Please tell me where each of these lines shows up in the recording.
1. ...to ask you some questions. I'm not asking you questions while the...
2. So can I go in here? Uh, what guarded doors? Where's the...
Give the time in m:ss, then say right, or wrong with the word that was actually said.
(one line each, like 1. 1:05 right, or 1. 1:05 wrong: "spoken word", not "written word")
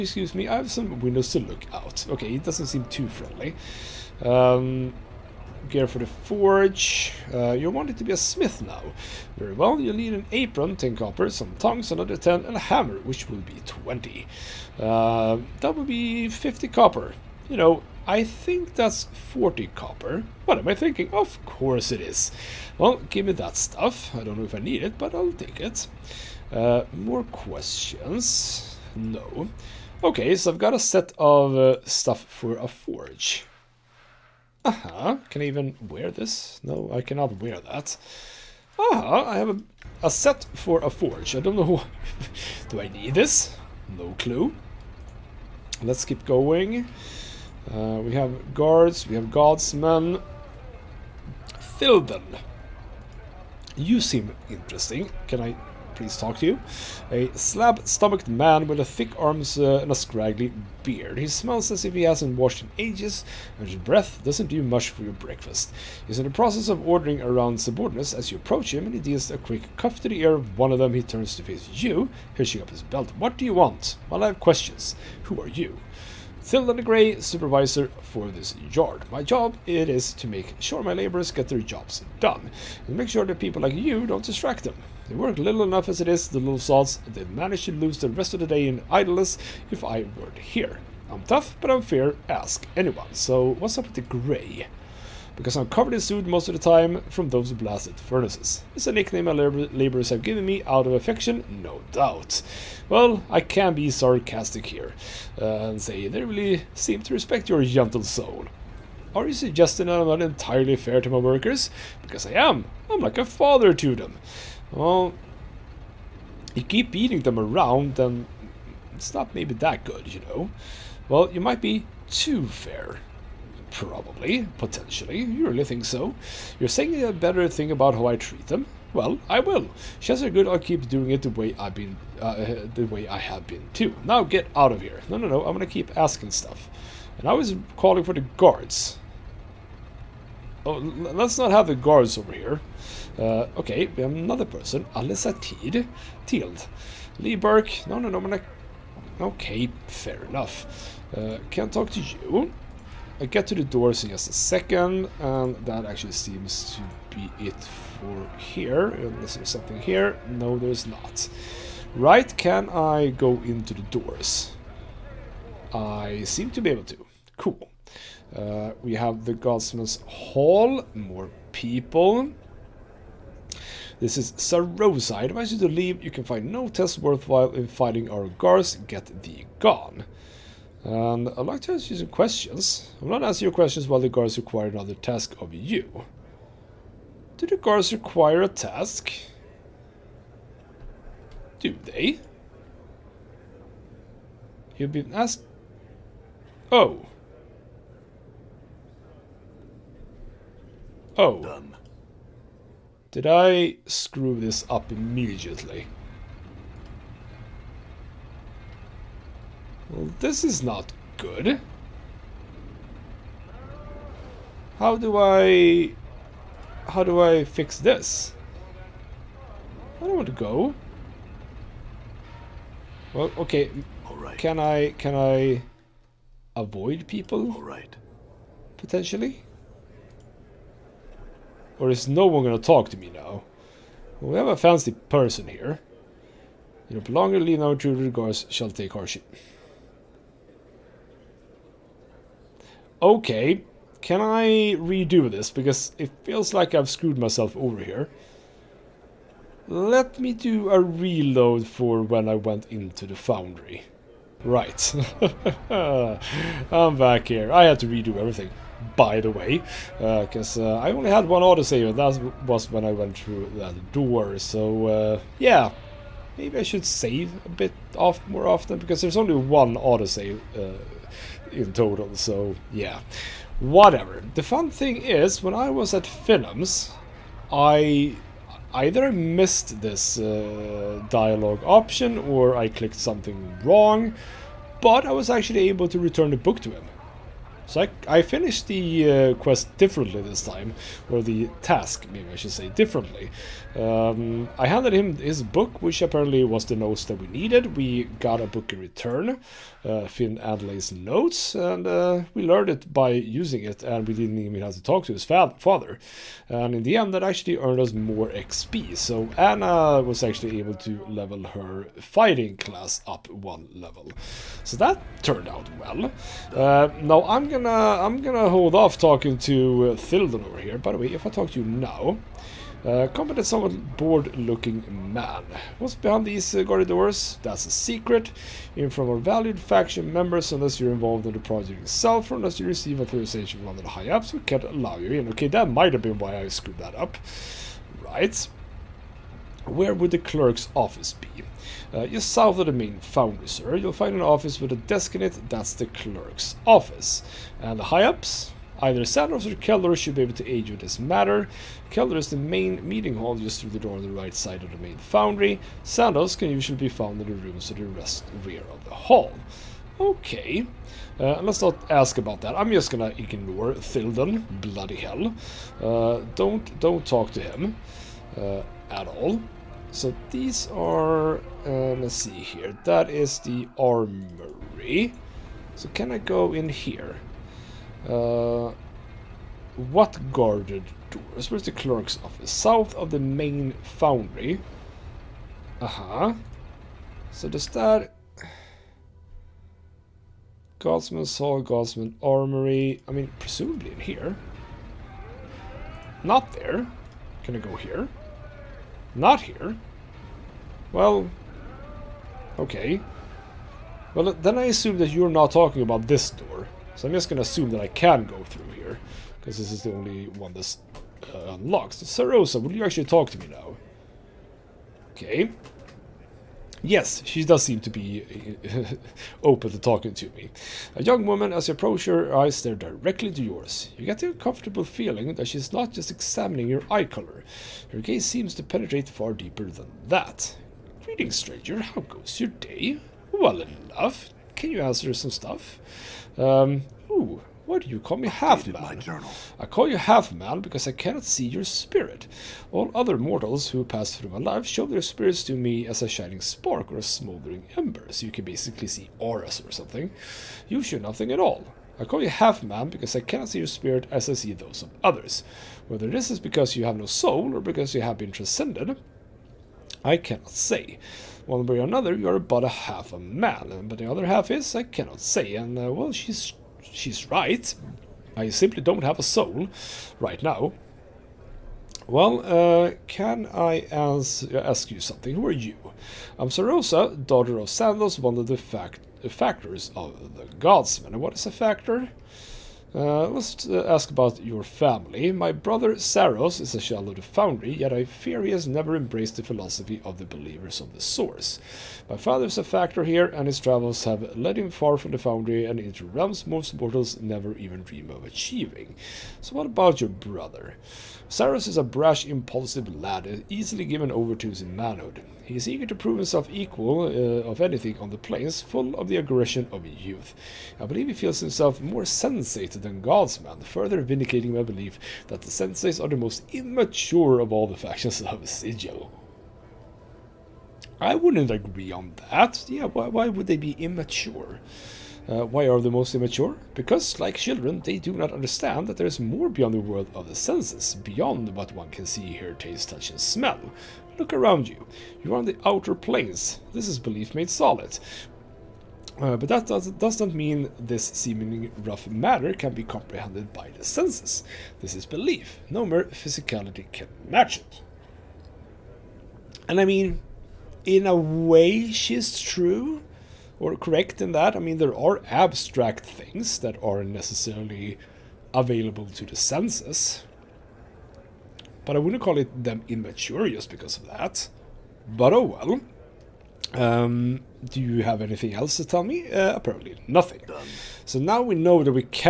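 1. 3:01 right
2. 6:15 right.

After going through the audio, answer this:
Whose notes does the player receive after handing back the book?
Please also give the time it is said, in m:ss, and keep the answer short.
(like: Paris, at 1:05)
Finn Adley's, at 5:00.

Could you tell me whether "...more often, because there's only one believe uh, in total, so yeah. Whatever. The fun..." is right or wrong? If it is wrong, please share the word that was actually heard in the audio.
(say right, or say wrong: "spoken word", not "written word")
wrong: "autosave", not "believe".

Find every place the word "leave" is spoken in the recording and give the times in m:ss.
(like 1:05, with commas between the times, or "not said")
2:55, 3:57.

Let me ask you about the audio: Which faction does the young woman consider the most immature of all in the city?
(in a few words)
The Sensates.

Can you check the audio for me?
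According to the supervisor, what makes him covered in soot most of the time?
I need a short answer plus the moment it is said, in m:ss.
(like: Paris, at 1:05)
Furnaces, at 1:37.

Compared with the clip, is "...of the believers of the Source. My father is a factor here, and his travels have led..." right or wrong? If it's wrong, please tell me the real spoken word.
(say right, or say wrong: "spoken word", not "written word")
right.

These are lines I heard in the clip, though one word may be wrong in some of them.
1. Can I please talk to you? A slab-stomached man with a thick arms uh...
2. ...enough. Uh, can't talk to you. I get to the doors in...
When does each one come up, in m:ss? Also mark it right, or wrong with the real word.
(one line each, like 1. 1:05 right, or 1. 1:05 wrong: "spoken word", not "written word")
1. 0:55 right
2. 2:30 right.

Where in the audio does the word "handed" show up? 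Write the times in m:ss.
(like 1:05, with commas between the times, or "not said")
4:54.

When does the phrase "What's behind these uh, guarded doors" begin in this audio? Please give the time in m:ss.
5:25.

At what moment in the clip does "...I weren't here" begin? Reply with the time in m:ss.
1:29.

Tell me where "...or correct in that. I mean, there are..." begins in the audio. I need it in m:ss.
9:13.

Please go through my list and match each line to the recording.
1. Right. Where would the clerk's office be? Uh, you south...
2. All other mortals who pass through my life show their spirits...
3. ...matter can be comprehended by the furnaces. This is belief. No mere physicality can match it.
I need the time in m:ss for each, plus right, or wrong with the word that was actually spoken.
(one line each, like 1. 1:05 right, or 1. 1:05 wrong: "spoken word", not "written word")
1. 5:38 right
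2. 7:22 right
3. 9:02 wrong: "senses", not "furnaces".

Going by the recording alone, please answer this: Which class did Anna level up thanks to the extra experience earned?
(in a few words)
Fighting class.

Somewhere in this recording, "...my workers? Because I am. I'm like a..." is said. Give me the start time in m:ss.
1:51.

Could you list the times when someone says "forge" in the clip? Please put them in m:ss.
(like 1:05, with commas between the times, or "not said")
0:06, 0:32, 0:40.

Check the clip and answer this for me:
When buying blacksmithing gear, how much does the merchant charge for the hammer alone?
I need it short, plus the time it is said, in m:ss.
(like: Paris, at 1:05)
20 copper, at 0:12.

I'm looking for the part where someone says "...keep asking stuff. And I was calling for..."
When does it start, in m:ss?
2:15.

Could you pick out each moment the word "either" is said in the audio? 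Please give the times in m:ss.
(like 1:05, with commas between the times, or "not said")
4:38, 5:48.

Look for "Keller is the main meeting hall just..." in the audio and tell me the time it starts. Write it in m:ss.
5:51.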